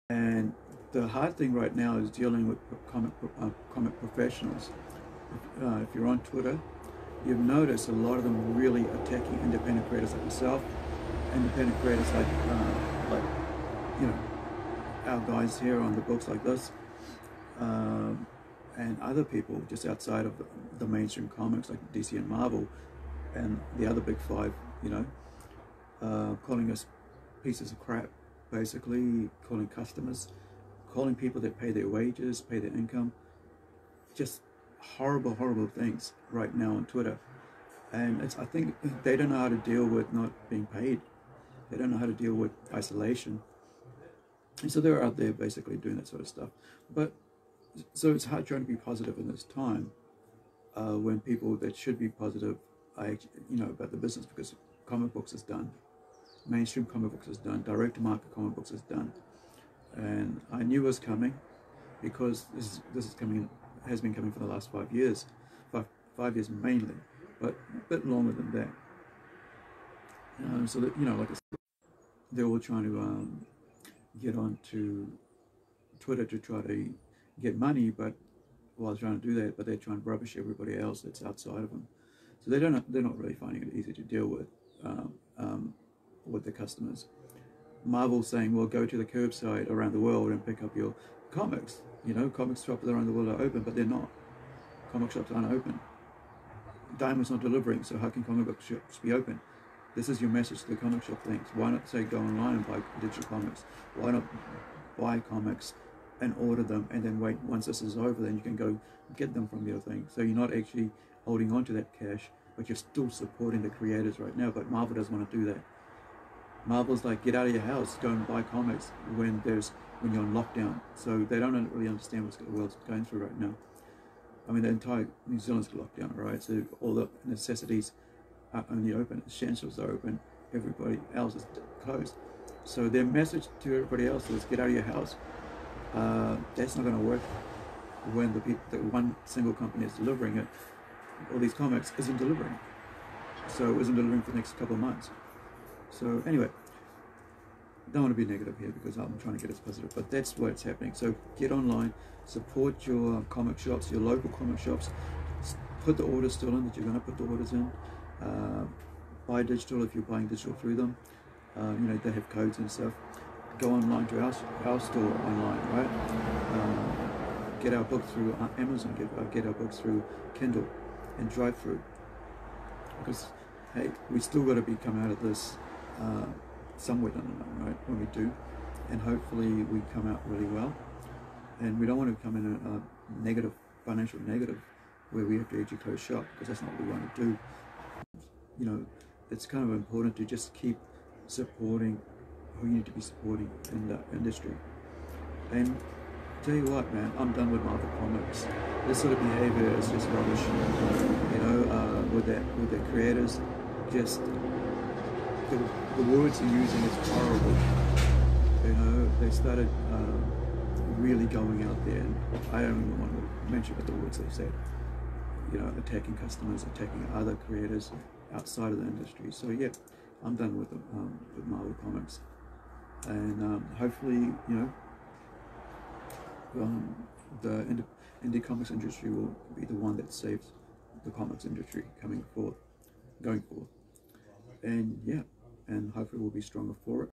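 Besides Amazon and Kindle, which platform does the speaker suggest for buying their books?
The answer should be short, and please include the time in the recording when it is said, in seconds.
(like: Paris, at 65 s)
DriveThru, at 171 s.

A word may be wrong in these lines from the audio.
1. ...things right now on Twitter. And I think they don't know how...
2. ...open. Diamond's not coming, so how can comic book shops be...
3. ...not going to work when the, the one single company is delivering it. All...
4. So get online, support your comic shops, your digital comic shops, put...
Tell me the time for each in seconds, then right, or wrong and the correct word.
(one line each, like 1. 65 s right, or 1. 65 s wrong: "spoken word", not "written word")
1. 35 s right
2. 95 s wrong: "delivering", not "coming"
3. 136 s right
4. 150 s wrong: "local", not "digital".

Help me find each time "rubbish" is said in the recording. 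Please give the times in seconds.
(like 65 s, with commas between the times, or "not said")
80 s, 200 s.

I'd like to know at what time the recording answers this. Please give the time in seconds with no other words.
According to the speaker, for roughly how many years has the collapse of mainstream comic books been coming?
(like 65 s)
64 s.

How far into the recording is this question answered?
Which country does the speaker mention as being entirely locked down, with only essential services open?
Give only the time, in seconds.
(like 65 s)
125 s.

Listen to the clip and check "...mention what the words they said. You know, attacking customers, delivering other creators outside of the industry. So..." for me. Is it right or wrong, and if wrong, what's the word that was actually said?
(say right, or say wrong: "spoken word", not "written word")
wrong: "attacking", not "delivering".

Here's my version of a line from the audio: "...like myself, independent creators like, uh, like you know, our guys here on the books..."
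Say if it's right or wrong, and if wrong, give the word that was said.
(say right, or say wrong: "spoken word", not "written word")
right.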